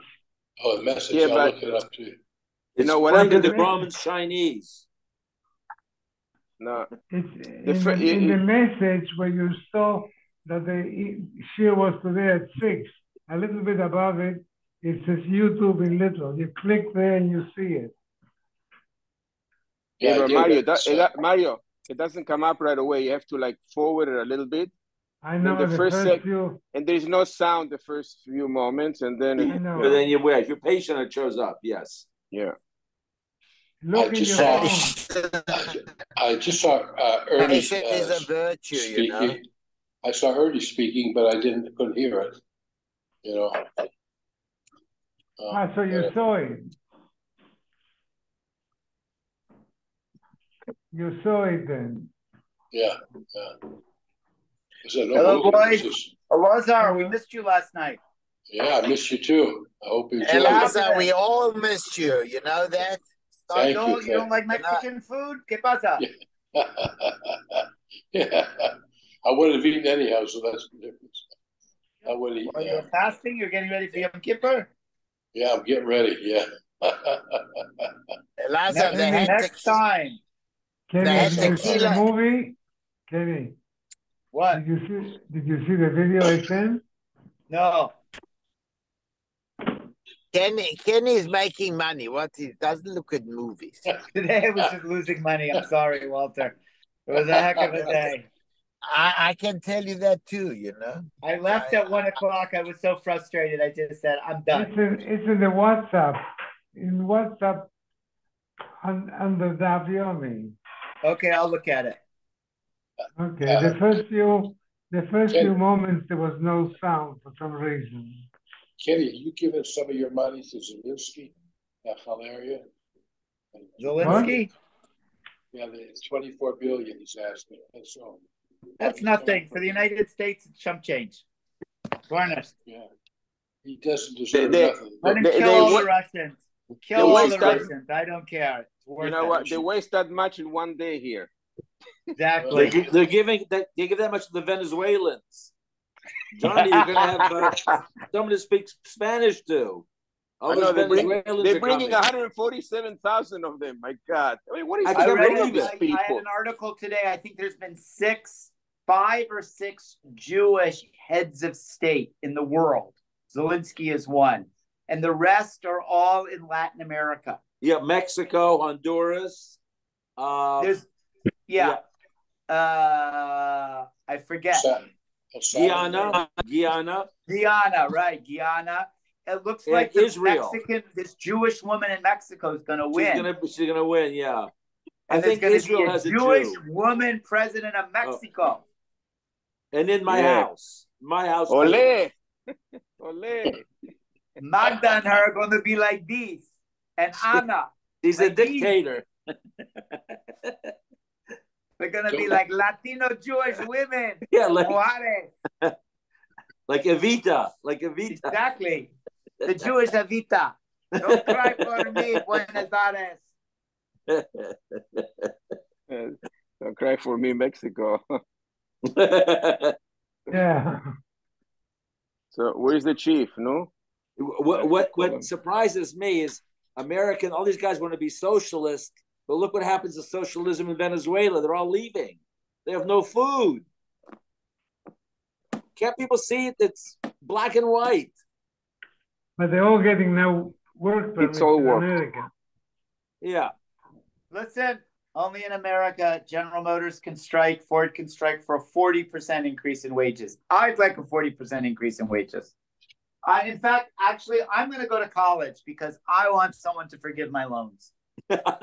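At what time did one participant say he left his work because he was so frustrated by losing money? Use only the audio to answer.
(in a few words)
1 o'clock.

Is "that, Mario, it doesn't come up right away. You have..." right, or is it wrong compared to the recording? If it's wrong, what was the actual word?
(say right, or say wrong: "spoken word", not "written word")
right.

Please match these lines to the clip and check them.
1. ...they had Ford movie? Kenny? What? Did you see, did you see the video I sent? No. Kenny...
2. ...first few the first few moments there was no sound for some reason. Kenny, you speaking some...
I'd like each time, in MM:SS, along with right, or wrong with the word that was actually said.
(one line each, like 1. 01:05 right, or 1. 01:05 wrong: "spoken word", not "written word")
1. 01:21 wrong: "The", not "Ford"
2. 01:53 wrong: "giving", not "speaking".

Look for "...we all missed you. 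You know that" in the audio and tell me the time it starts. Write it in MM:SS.
01:00.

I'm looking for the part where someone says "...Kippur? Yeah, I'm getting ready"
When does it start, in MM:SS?
01:14.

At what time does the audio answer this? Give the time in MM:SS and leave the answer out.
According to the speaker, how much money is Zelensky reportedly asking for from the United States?
02:06.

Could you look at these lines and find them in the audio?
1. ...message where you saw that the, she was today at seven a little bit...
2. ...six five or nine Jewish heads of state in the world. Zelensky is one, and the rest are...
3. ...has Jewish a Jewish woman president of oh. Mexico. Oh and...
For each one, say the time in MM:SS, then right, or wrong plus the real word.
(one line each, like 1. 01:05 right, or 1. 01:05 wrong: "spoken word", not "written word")
1. 00:08 wrong: "six", not "seven"
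2. 02:37 wrong: "six", not "nine"
3. 03:05 right.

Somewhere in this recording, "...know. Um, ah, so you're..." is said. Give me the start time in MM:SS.
00:43.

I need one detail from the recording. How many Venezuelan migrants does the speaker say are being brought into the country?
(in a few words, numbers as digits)
147,000.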